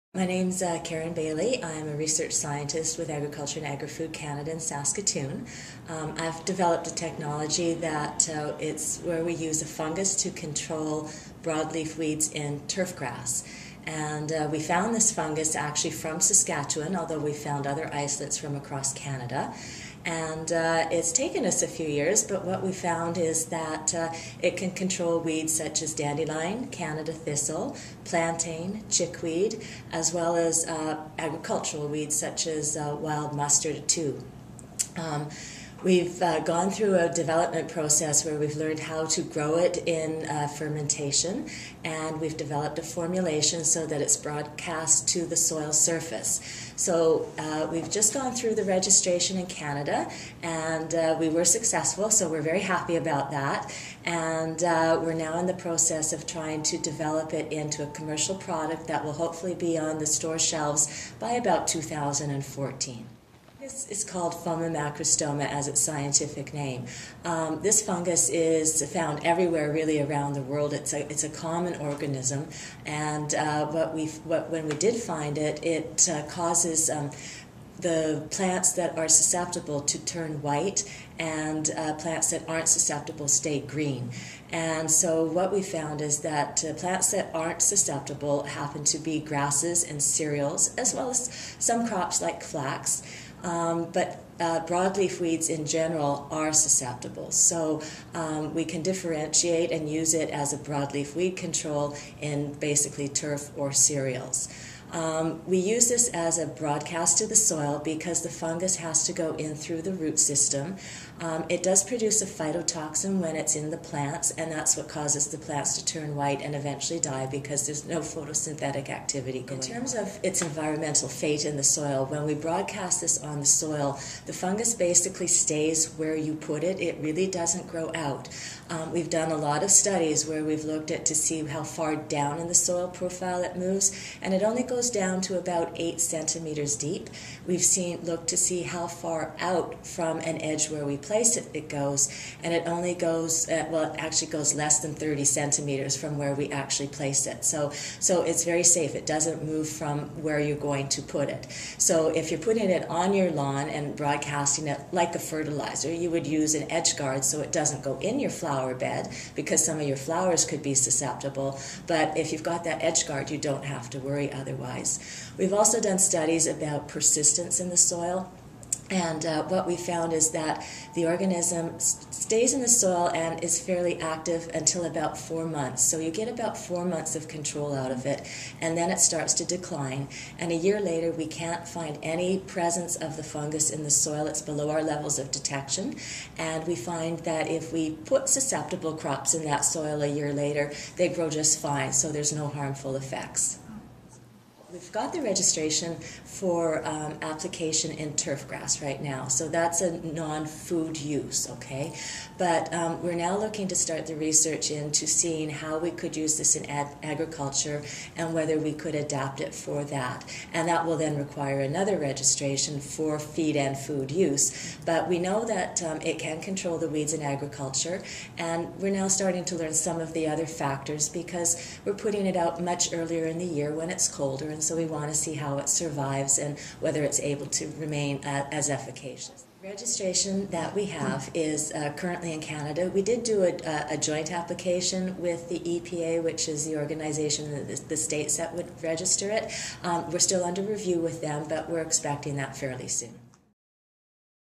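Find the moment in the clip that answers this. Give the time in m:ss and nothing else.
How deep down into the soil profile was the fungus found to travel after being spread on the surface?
2:15.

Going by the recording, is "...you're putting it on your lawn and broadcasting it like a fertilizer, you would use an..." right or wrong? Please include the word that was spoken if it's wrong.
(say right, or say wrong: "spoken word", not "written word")
right.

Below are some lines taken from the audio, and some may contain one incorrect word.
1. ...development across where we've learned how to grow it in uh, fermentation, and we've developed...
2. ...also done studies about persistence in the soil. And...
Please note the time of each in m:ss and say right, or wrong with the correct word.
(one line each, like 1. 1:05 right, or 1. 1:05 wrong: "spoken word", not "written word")
1. 0:37 wrong: "process", not "across"
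2. 2:45 right.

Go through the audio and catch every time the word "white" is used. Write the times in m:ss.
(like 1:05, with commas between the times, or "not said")
1:20, 1:56.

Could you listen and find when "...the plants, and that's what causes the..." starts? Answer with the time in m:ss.
1:53.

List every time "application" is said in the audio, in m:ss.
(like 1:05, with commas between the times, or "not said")
3:17, 3:54.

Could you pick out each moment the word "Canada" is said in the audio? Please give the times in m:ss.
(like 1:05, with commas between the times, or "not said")
0:04, 0:18, 0:26, 0:49, 3:52.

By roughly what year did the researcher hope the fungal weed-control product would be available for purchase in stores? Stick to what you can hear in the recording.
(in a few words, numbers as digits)
2014.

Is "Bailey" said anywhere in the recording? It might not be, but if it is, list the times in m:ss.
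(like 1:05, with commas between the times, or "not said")
0:01.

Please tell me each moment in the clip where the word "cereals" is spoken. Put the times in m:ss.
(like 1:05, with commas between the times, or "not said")
1:30, 1:43.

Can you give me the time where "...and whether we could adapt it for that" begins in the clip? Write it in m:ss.
3:28.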